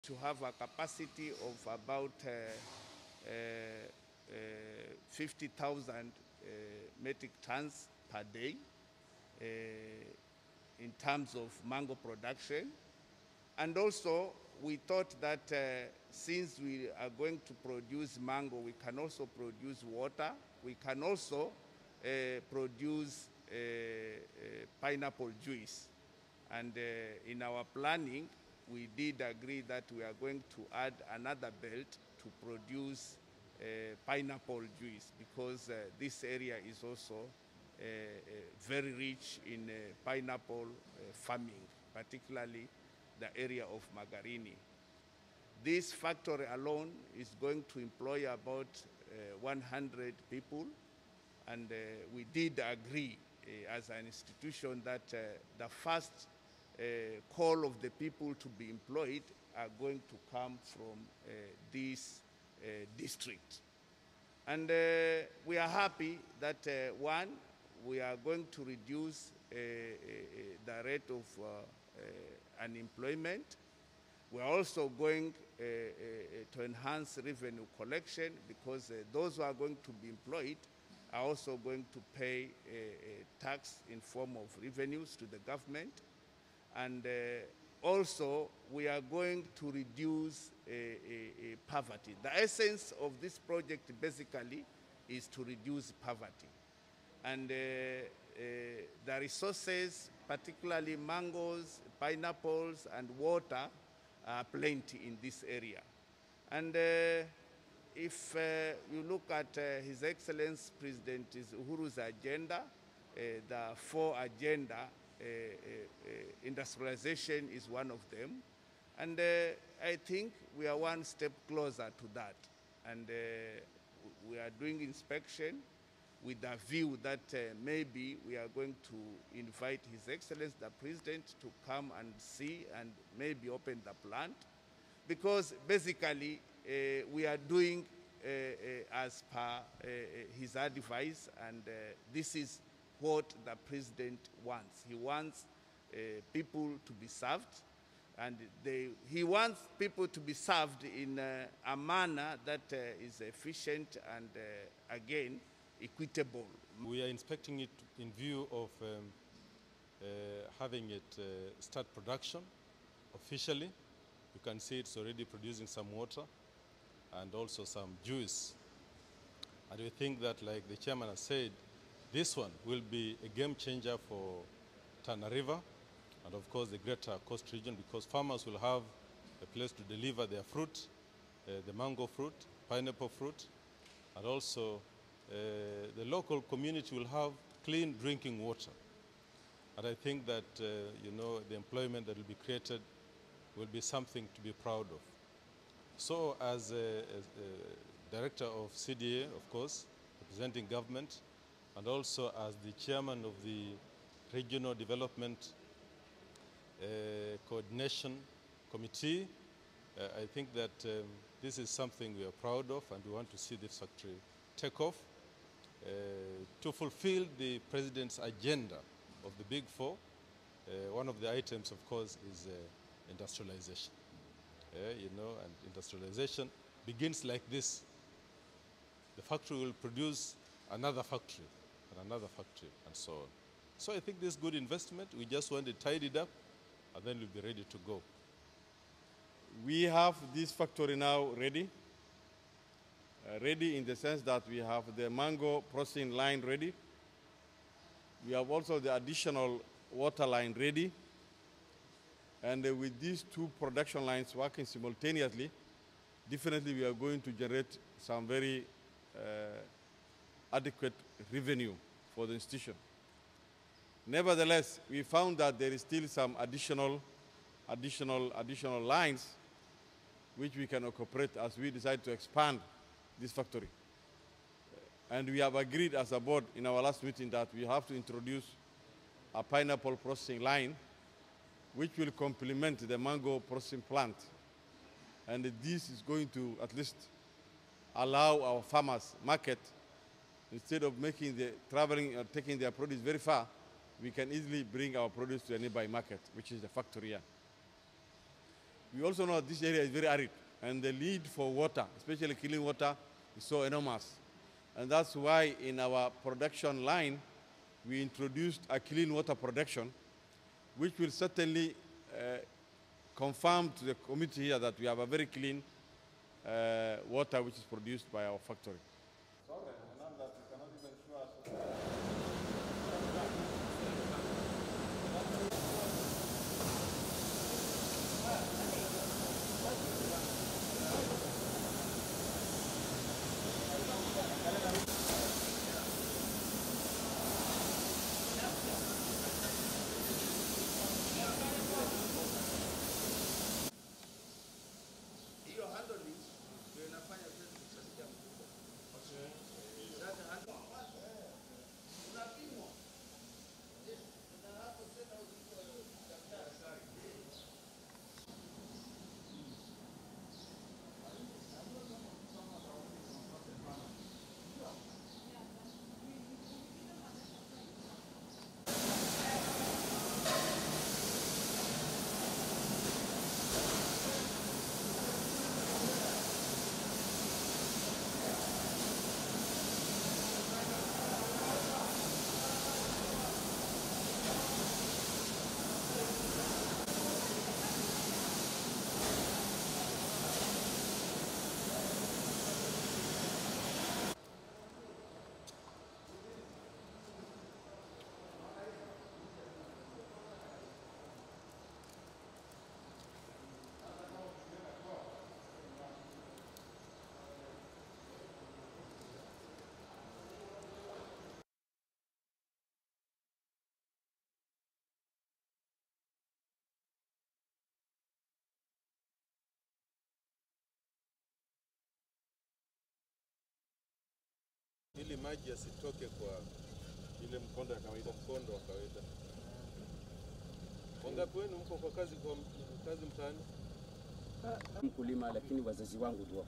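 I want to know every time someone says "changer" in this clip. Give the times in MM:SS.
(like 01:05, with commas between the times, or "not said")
02:53.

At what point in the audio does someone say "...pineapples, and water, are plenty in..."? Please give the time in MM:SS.
01:41.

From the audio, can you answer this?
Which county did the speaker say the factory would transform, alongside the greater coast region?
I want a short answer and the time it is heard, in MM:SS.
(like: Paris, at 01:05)
Tana River, at 02:55.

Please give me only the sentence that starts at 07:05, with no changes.
ili maji yasitoke kwa ile mkondo ya kawaida, mkondo wa kawaida.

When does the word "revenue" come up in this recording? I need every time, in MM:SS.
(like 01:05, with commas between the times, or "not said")
01:17, 01:24, 04:21.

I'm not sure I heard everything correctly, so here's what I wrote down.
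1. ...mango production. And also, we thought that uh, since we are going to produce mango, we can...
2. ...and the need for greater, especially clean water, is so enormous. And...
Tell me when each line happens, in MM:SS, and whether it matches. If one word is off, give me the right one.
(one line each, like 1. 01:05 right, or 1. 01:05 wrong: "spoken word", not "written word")
1. 00:11 right
2. 05:00 wrong: "water", not "greater".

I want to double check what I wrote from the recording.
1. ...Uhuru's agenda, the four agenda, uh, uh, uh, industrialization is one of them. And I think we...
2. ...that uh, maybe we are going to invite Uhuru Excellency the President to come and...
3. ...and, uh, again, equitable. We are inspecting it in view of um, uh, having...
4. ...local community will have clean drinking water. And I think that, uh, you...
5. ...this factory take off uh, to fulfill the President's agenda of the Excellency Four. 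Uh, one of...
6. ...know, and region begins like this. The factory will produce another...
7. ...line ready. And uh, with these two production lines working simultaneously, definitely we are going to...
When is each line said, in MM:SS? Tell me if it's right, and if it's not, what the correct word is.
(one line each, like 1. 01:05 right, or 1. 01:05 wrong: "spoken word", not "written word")
1. 01:51 right
2. 02:07 wrong: "His", not "Uhuru"
3. 02:34 right
4. 03:06 right
5. 03:33 wrong: "Big", not "Excellency"
6. 03:45 wrong: "industrialization", not "region"
7. 04:10 right.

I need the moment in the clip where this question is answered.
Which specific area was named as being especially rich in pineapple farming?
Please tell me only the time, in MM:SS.
00:43.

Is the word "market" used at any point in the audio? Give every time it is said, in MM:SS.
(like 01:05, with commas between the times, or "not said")
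04:49, 04:55.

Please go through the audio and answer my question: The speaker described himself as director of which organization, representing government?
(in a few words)
CDA.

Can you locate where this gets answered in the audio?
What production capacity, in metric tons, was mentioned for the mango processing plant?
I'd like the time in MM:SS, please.
00:05.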